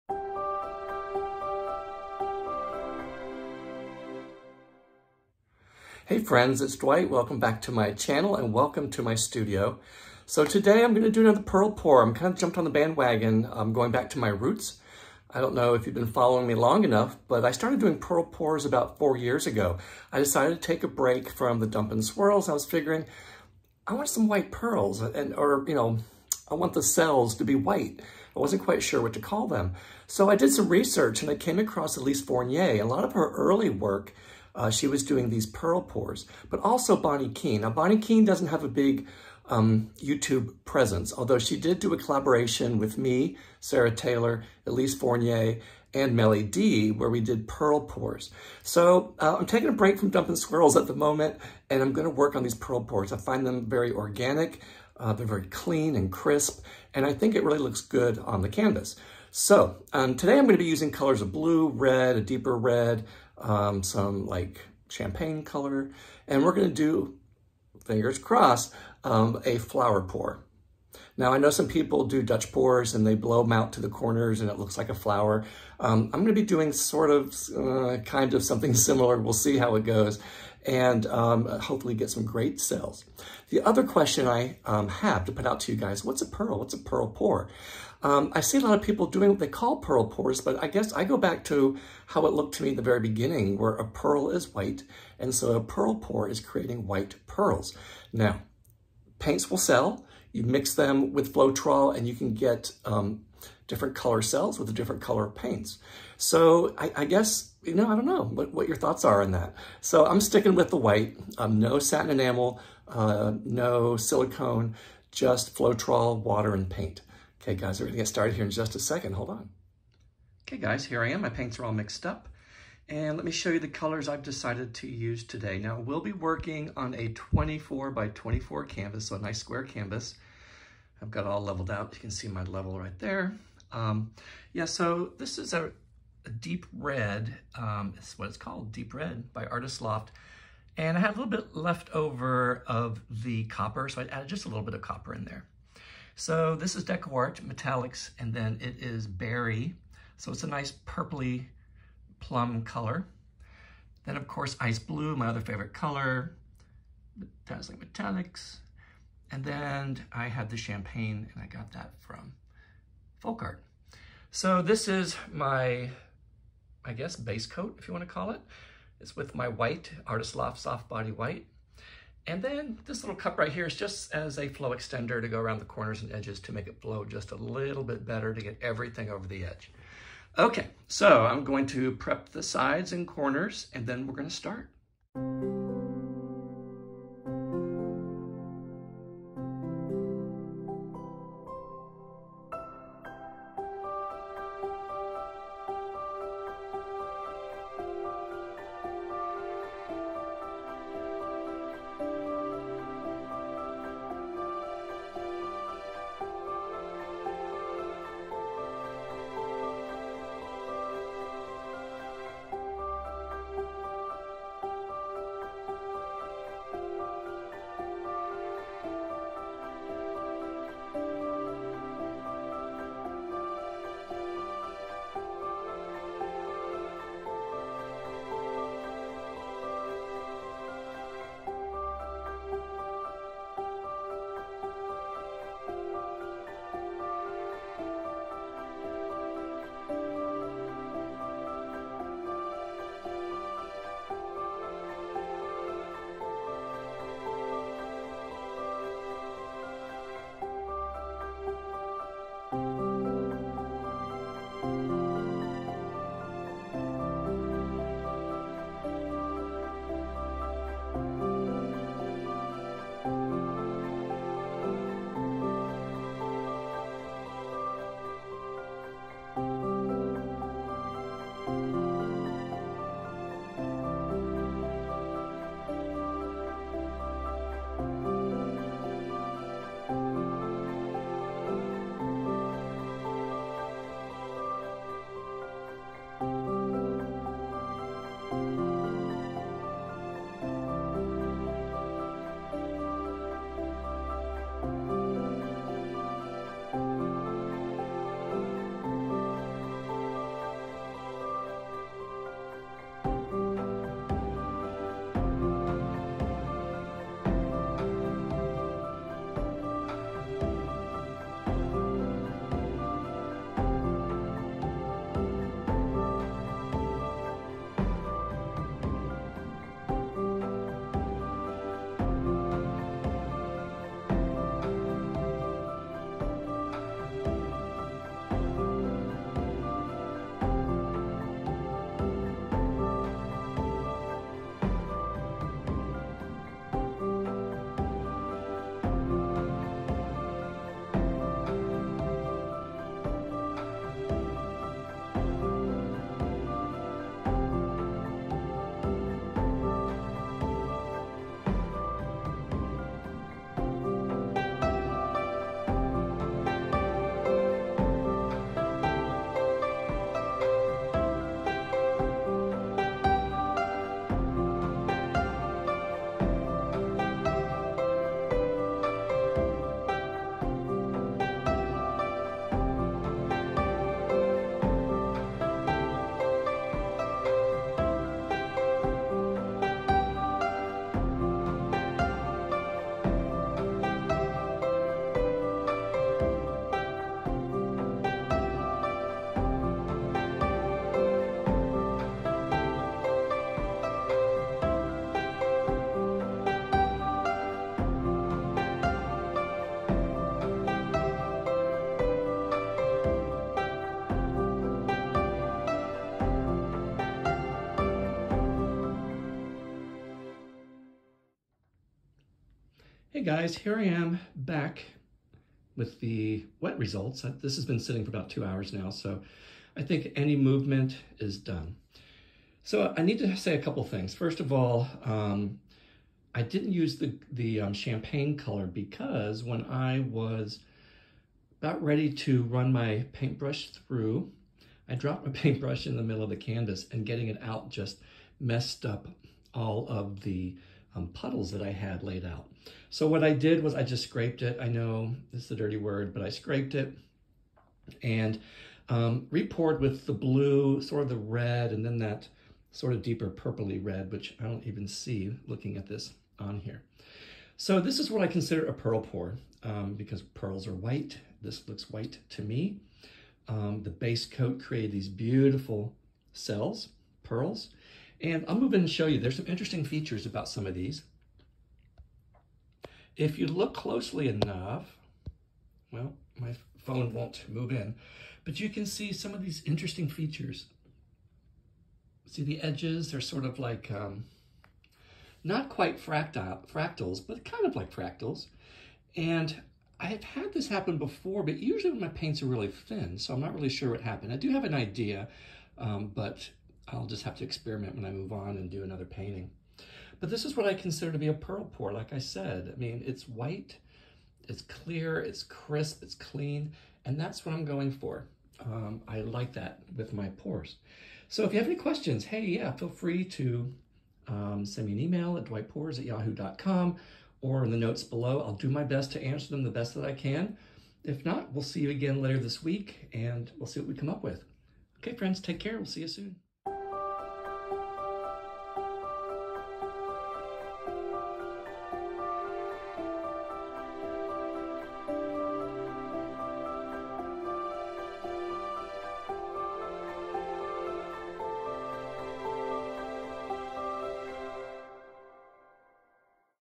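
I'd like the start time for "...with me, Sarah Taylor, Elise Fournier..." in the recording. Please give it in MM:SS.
00:42.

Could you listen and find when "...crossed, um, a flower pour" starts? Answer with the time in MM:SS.
01:08.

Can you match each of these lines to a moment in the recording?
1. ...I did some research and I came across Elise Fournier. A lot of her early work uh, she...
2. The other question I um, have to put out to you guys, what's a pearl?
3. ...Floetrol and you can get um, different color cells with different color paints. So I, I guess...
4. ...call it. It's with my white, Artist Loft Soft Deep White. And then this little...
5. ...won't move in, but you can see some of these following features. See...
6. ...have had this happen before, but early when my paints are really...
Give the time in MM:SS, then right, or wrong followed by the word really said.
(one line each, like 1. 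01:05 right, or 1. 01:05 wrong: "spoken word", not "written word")
1. 00:30 right
2. 01:23 right
3. 01:41 right
4. 02:48 wrong: "Body", not "Deep"
5. 07:57 wrong: "interesting", not "following"
6. 08:10 wrong: "usually", not "early".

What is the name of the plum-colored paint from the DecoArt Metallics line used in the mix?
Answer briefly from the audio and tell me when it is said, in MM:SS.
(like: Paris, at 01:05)
Berry, at 02:29.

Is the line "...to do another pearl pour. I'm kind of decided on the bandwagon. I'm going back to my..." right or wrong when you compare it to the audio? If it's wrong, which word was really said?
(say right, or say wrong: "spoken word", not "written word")
wrong: "jumped", not "decided".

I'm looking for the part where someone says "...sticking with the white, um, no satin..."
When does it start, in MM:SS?
01:50.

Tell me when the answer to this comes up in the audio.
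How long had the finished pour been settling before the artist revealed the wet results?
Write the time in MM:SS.
06:58.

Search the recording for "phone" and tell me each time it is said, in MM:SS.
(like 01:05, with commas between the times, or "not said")
07:56.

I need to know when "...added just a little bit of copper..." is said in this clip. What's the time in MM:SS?
02:24.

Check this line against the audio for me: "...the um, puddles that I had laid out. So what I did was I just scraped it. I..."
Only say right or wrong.
right.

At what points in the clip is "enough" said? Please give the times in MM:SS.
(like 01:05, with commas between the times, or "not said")
00:16, 07:54.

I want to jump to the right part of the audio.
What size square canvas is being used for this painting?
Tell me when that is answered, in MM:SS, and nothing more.
02:07.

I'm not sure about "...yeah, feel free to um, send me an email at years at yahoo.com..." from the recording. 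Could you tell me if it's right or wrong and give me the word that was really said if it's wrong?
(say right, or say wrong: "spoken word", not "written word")
wrong: "dwightpours", not "years".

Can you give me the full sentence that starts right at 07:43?
Um, the base coat created these beautiful cells, pearls.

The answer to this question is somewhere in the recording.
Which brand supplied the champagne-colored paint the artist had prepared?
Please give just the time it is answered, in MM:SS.
02:43.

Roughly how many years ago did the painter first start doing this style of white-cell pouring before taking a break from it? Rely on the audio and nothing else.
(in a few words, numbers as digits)
4 years.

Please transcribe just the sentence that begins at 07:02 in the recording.
So I need to say a couple things.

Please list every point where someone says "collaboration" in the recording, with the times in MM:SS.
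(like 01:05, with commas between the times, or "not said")
00:41.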